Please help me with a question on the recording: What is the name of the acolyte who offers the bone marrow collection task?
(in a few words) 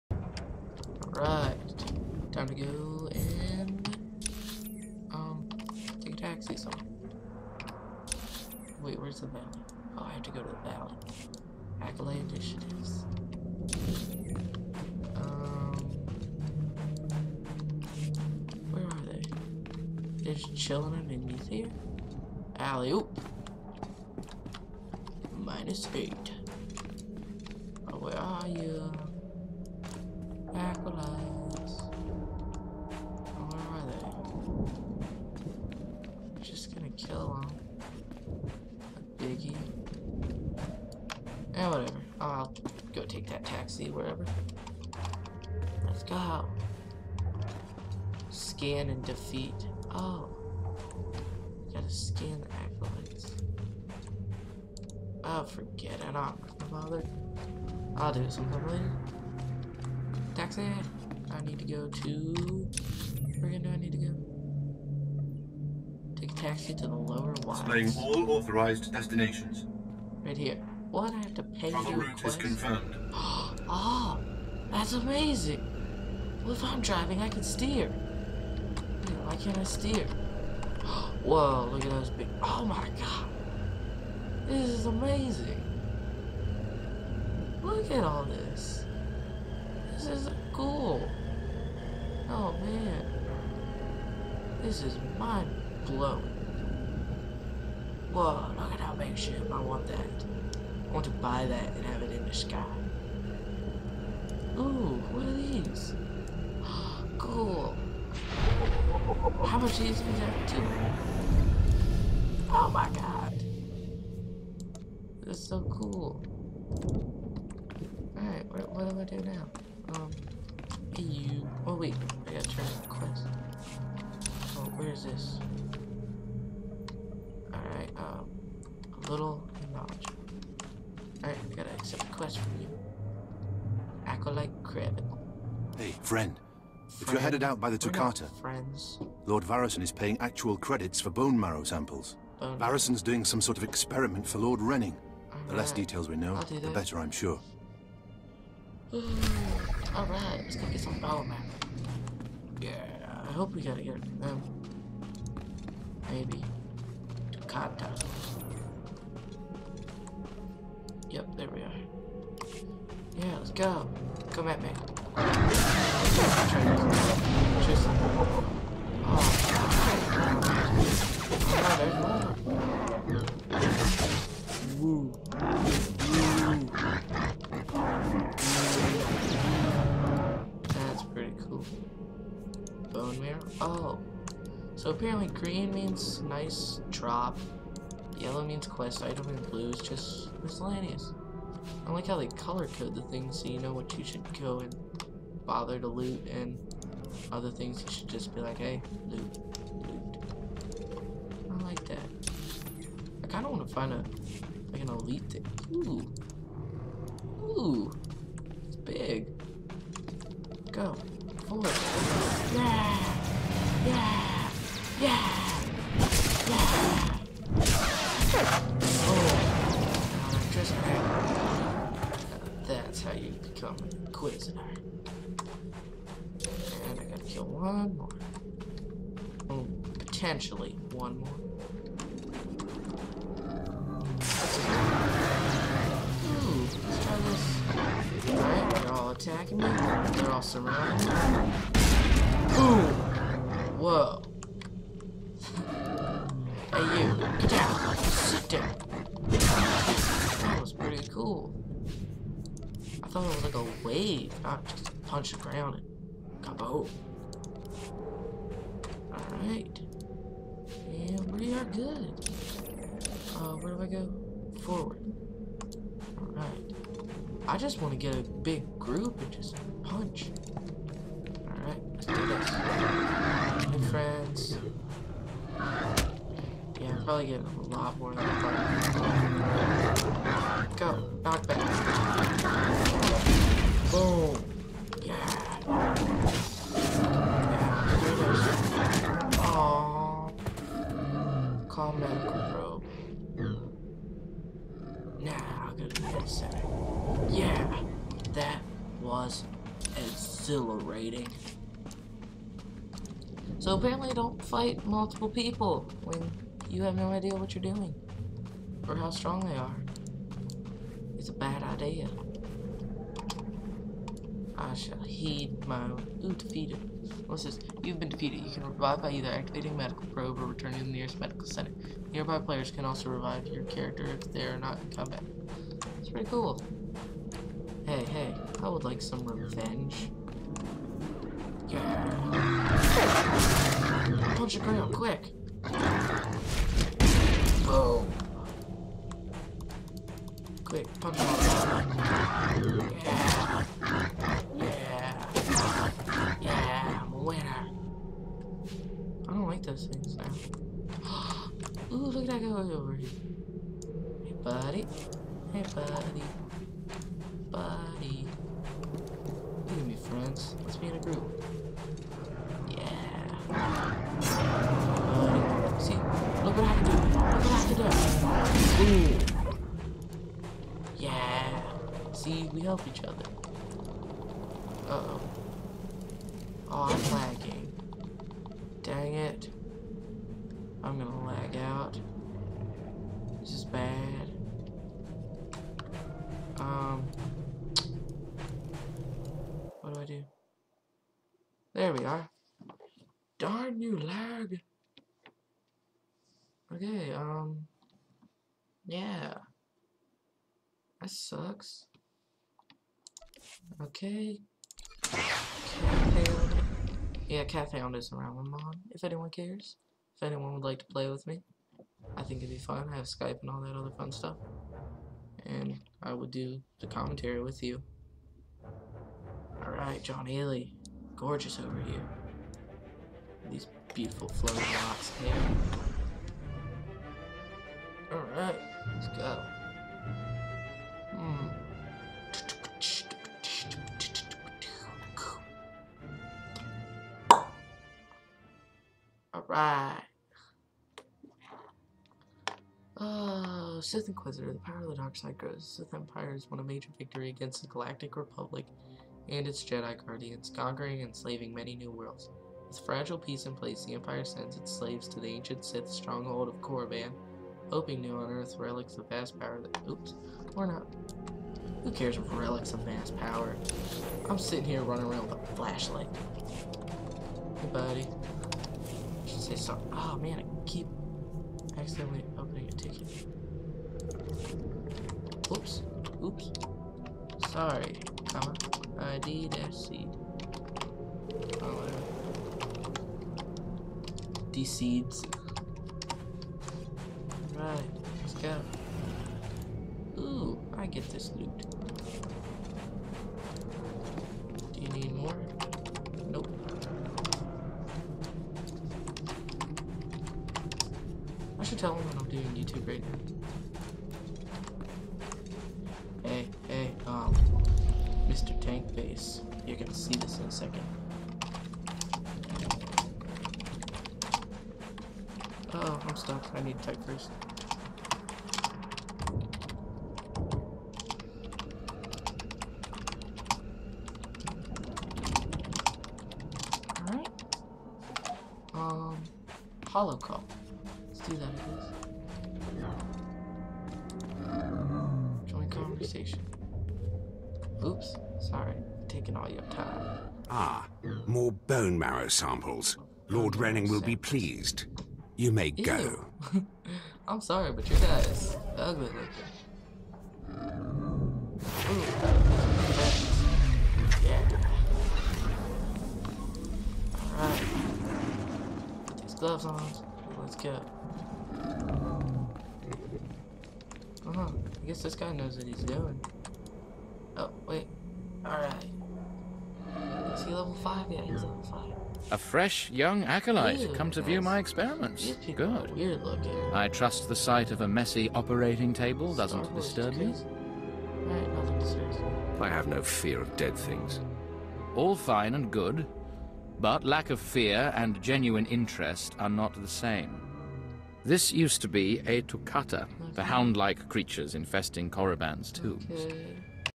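Acolyte Craven.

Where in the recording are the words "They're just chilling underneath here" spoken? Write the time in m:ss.
0:20.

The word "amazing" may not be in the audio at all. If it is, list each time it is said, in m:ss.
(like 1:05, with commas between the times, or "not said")
1:14, 1:24.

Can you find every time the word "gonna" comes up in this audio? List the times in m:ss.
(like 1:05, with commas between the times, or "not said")
8:29.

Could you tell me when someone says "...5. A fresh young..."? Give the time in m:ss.
9:31.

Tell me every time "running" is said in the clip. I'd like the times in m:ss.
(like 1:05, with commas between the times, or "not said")
7:44.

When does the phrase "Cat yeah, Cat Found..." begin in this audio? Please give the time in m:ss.
6:45.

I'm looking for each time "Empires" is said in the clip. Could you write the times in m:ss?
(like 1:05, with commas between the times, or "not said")
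7:25, 7:33.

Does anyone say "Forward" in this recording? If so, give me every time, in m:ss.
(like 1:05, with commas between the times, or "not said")
4:24.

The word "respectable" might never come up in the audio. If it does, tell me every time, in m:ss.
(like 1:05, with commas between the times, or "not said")
not said.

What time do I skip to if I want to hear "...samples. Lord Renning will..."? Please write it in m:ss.
9:02.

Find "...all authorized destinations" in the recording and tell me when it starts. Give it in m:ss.
1:07.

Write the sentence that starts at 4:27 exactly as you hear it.
I just want to get a big group and just punch.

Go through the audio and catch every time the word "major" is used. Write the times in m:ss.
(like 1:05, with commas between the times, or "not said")
7:26.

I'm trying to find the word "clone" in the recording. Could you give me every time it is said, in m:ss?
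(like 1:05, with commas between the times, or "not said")
not said.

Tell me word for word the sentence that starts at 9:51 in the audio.
This used to be a Tukata, okay.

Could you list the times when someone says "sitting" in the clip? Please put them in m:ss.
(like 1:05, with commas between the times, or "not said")
7:44.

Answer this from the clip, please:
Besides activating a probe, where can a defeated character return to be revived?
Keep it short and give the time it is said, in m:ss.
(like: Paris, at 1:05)
nearest medical center, at 5:20.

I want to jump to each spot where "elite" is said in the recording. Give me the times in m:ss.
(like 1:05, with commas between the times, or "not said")
3:24.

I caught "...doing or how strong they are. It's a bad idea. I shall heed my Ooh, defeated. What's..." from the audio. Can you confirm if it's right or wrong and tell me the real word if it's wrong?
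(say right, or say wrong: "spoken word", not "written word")
right.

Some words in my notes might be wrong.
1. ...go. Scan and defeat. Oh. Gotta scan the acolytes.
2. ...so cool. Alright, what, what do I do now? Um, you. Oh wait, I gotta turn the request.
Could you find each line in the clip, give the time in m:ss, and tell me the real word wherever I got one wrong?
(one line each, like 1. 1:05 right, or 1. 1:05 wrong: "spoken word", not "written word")
1. 0:46 right
2. 1:55 wrong: "quest", not "request".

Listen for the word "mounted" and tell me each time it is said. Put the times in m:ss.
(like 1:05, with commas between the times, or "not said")
not said.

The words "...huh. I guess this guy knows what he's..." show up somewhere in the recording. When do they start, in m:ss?
9:24.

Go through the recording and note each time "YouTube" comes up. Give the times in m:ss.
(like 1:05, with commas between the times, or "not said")
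8:22.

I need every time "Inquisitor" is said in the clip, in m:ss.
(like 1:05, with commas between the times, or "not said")
3:44, 7:24.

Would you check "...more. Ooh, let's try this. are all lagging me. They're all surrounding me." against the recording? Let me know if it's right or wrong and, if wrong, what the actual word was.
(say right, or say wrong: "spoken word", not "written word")
wrong: "attacking", not "lagging".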